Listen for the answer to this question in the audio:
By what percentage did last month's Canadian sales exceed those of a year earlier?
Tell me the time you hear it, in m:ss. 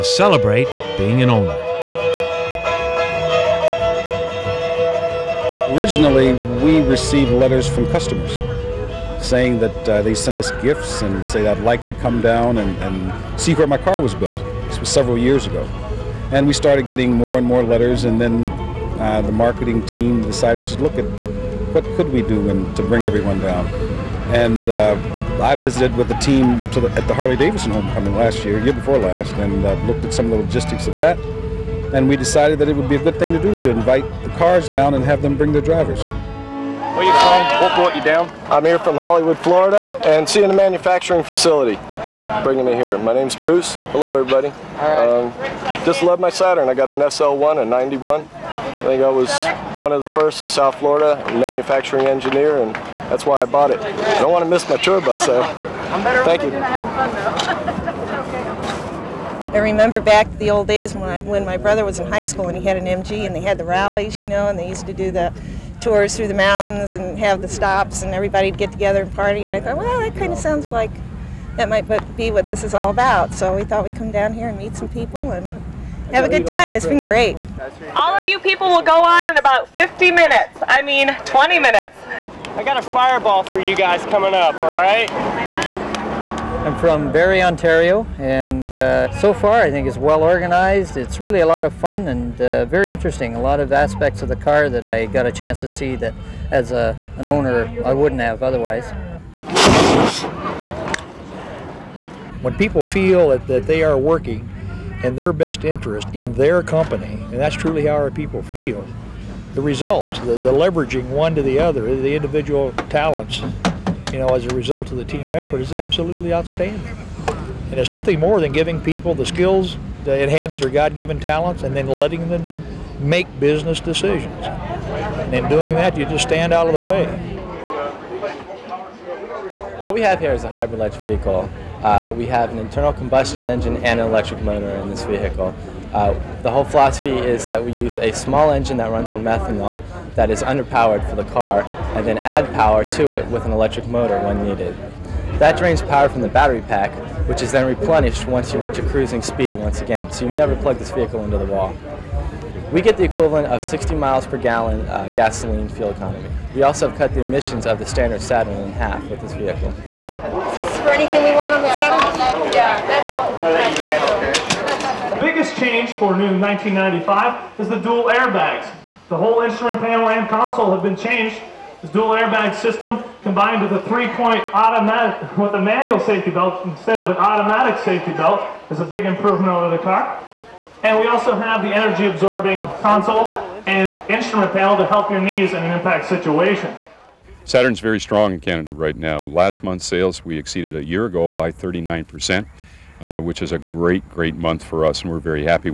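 3:11.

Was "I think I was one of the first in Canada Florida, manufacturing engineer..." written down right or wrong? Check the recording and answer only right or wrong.
wrong.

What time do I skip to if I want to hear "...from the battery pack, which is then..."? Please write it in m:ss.
2:26.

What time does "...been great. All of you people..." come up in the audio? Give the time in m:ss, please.
1:16.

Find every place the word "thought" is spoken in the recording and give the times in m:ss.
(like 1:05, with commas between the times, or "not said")
1:09, 1:13.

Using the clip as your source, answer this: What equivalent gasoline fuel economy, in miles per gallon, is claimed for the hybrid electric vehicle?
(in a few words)
60.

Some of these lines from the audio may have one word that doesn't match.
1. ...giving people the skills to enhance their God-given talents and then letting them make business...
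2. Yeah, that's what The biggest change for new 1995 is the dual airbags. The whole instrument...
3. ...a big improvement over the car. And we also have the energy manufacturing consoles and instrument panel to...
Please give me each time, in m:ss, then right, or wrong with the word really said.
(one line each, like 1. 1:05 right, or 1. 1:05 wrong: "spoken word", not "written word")
1. 1:58 right
2. 2:42 right
3. 2:58 wrong: "absorbing", not "manufacturing".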